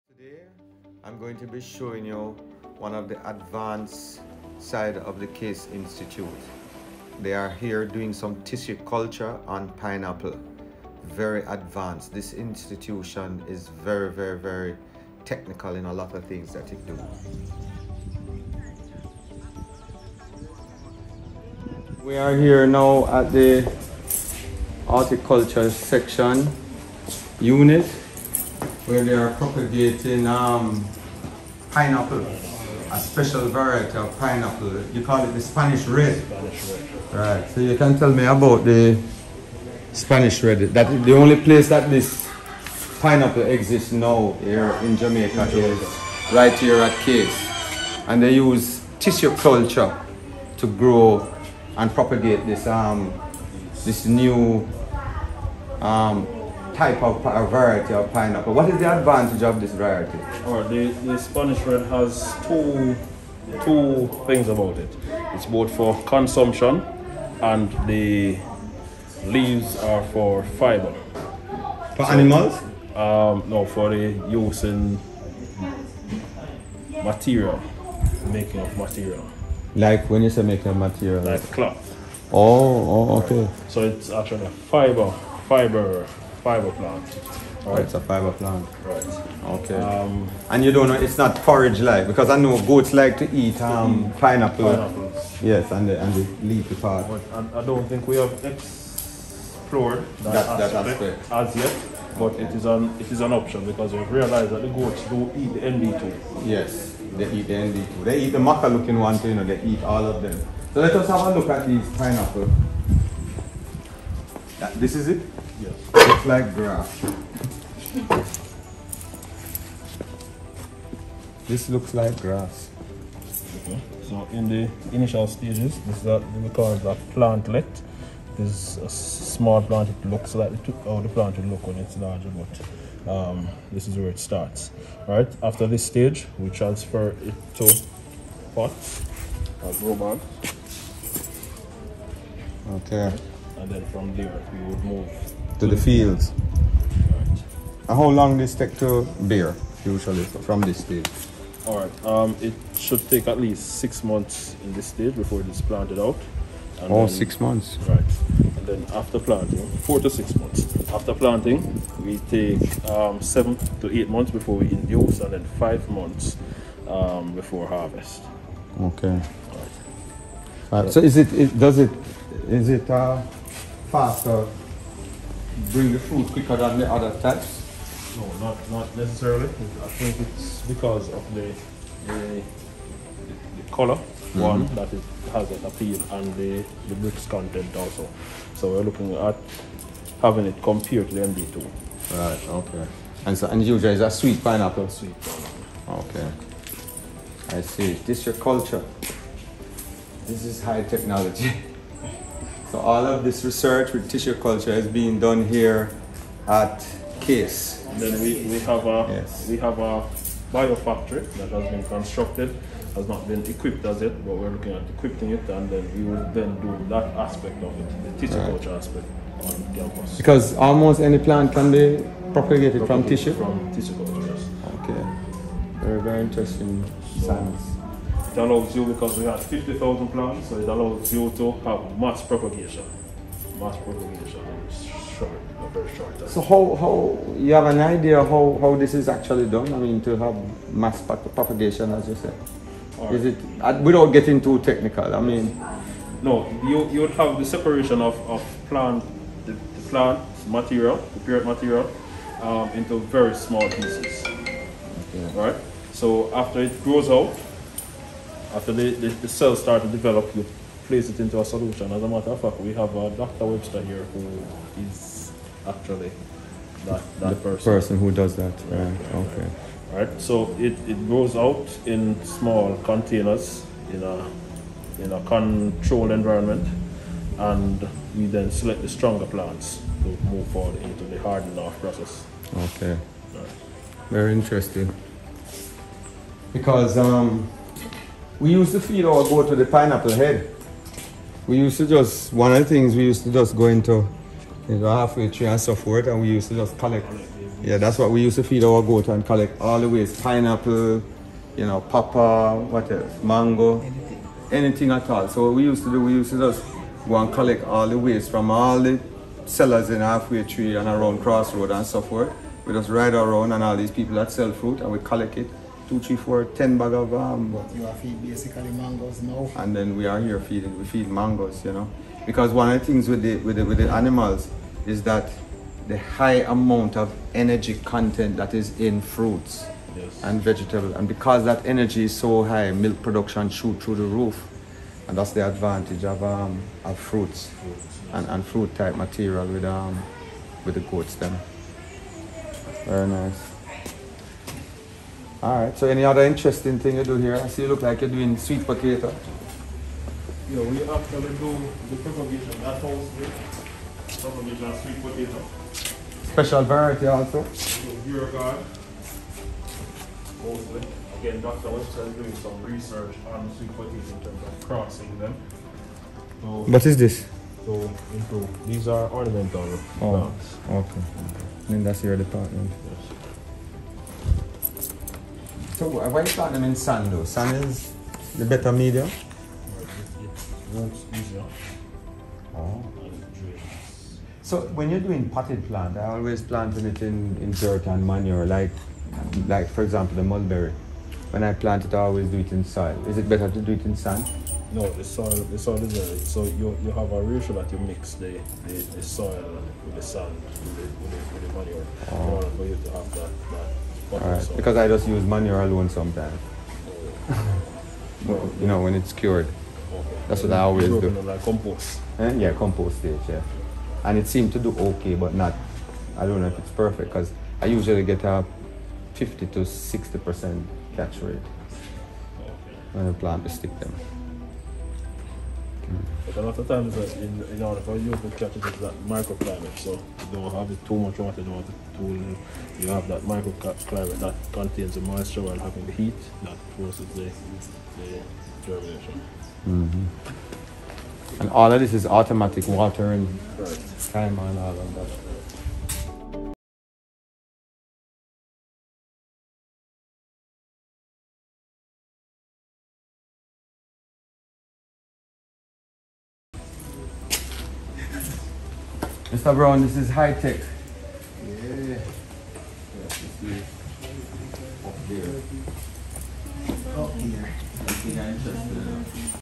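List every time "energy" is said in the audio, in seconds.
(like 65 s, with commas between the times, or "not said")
327 s, 331 s.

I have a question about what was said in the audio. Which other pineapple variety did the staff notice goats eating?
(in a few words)
MD2.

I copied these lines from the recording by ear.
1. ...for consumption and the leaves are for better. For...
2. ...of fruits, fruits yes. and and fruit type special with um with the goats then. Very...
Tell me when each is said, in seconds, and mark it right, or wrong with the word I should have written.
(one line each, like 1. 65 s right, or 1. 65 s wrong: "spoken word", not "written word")
1. 65 s wrong: "fiber", not "better"
2. 336 s wrong: "material", not "special".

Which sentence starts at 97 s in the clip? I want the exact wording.
But I, don't think we have explored that, that, that aspect, as yet.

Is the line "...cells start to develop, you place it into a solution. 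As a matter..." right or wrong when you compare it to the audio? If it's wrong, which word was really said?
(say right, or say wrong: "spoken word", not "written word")
right.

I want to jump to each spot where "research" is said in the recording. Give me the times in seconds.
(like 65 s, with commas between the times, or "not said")
203 s, 362 s.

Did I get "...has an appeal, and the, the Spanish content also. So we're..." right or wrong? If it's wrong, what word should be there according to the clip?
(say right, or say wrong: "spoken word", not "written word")
wrong: "Brix", not "Spanish".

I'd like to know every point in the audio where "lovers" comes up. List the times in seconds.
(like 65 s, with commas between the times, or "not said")
not said.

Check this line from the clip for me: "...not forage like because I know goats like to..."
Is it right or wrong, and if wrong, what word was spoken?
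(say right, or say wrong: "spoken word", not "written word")
right.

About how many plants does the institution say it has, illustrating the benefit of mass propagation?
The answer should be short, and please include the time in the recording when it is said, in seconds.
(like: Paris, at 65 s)
50,000, at 229 s.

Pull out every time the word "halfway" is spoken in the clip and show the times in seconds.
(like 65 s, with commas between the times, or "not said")
294 s, 310 s.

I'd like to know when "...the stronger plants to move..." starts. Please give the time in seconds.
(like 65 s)
278 s.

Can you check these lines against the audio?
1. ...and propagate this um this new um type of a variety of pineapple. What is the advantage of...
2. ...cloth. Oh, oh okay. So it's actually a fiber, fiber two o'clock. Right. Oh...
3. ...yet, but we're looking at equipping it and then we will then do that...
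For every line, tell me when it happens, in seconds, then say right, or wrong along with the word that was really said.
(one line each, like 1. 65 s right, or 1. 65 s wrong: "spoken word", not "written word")
1. 51 s right
2. 81 s wrong: "five", not "two"
3. 214 s right.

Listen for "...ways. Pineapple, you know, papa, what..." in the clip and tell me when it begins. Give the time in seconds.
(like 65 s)
299 s.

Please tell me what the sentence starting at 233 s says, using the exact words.
Mass propagation is short, very short time.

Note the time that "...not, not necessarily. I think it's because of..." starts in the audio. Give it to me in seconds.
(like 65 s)
178 s.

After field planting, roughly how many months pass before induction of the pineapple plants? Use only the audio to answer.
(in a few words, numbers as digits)
7 to 8 months.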